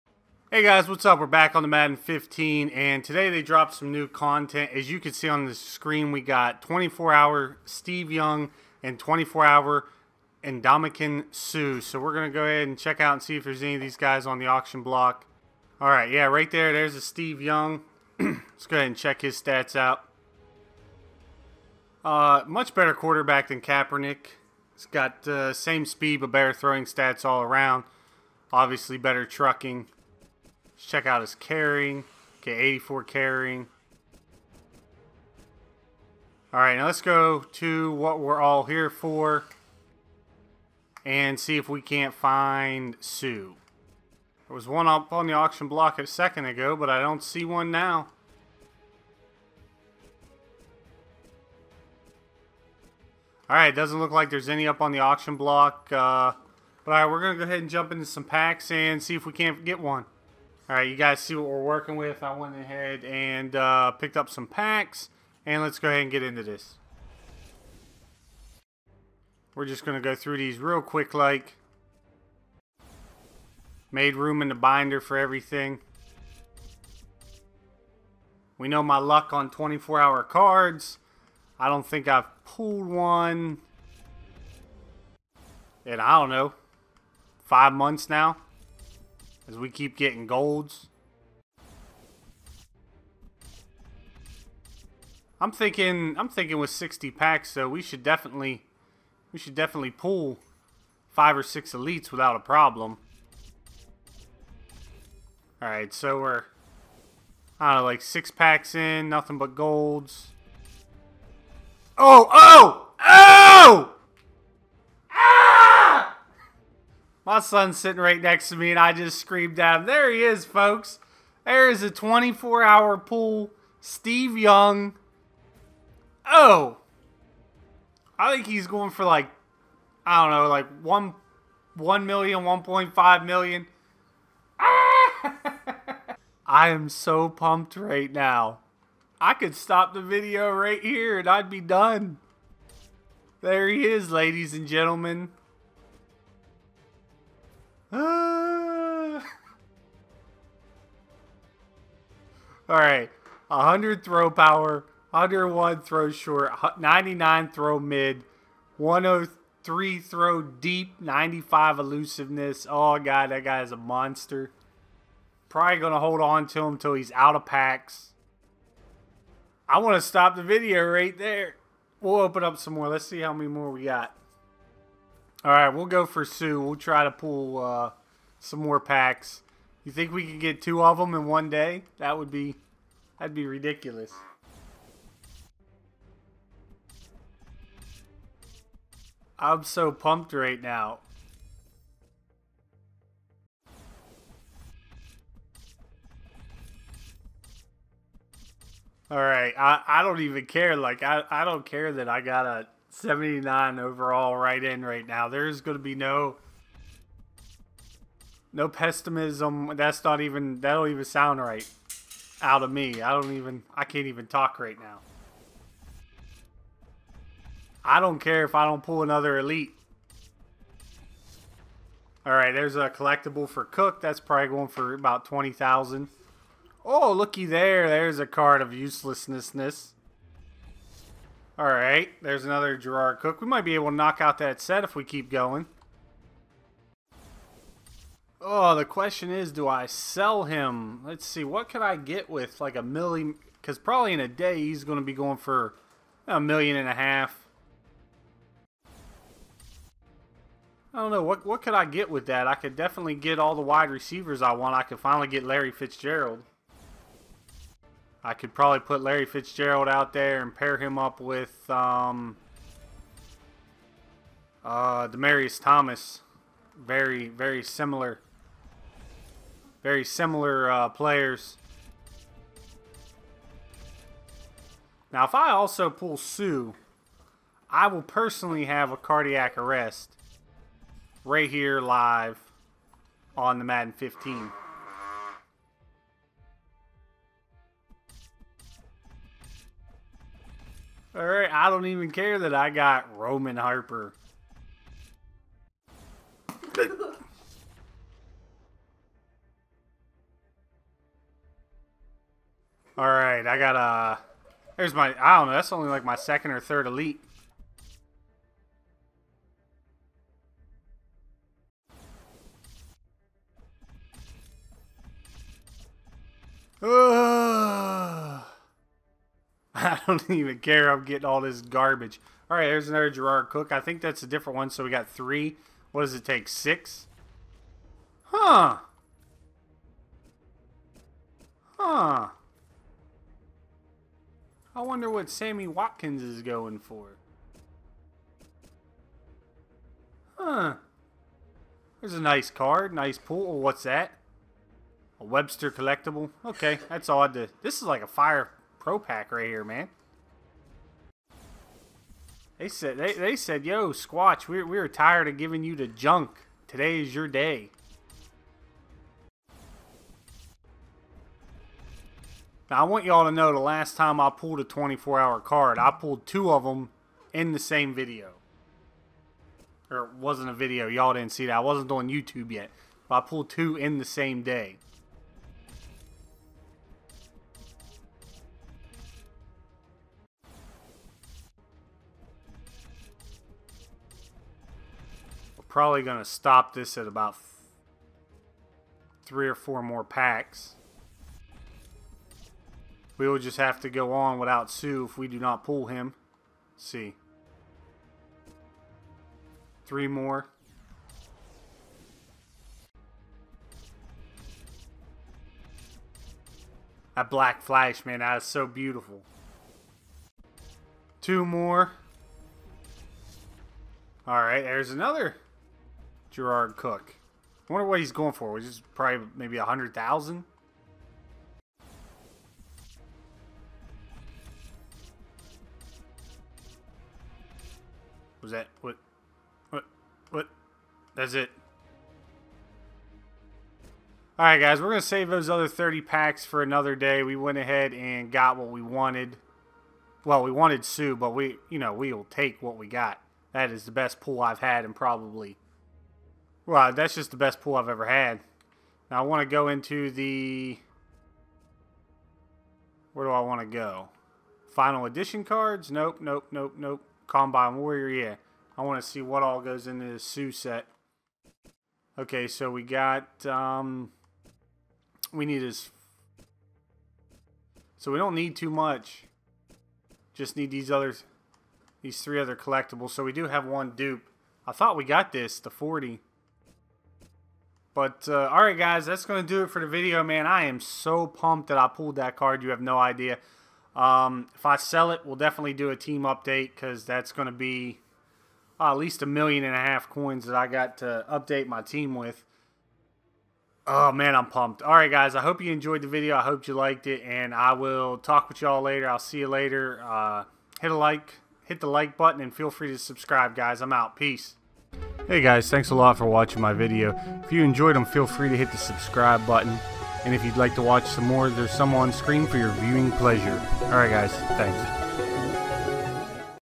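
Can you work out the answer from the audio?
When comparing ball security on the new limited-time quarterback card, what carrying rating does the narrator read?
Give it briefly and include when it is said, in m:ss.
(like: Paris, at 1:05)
84, at 0:32.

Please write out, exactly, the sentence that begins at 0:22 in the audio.
Uh, much better quarterback than Kaepernick.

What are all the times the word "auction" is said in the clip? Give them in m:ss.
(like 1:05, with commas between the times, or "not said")
0:14, 0:45, 0:54.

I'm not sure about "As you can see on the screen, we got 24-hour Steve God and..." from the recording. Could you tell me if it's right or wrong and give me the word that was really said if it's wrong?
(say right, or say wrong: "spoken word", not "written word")
wrong: "Young", not "God".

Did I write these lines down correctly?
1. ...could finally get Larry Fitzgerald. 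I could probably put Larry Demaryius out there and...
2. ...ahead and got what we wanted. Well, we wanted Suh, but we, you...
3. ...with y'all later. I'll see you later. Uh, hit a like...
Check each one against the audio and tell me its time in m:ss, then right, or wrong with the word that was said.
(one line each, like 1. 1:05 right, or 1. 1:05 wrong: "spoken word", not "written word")
1. 4:14 wrong: "Fitzgerald", not "Demaryius"
2. 7:17 right
3. 8:18 right.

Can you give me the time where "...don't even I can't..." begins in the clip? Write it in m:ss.
3:33.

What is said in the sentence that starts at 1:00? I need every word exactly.
All right, you guys see what we're working with.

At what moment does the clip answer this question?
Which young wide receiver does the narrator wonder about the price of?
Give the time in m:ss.
5:35.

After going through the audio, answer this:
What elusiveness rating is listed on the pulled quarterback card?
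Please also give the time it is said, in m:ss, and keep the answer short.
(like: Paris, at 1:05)
95, at 2:41.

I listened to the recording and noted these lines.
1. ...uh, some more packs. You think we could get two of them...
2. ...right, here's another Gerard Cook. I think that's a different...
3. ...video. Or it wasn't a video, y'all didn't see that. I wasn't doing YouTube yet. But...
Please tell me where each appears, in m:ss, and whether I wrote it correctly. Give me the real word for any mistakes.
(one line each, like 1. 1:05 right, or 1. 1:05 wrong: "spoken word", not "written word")
1. 2:57 right
2. 5:22 right
3. 6:07 right.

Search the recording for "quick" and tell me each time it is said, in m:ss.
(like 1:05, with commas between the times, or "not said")
1:10.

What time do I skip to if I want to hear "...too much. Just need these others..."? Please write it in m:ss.
7:48.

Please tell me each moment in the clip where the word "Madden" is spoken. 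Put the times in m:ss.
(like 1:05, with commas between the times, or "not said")
0:01, 4:43.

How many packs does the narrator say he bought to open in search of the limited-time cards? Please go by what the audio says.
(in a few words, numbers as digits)
60.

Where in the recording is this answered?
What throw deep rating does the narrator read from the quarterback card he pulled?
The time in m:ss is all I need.
2:38.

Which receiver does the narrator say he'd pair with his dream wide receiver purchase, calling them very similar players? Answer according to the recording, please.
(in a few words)
Demaryius Thomas.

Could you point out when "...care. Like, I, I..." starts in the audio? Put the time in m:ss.
3:20.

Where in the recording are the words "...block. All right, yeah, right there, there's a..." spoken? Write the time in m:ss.
0:14.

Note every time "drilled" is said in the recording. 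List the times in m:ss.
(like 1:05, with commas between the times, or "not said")
not said.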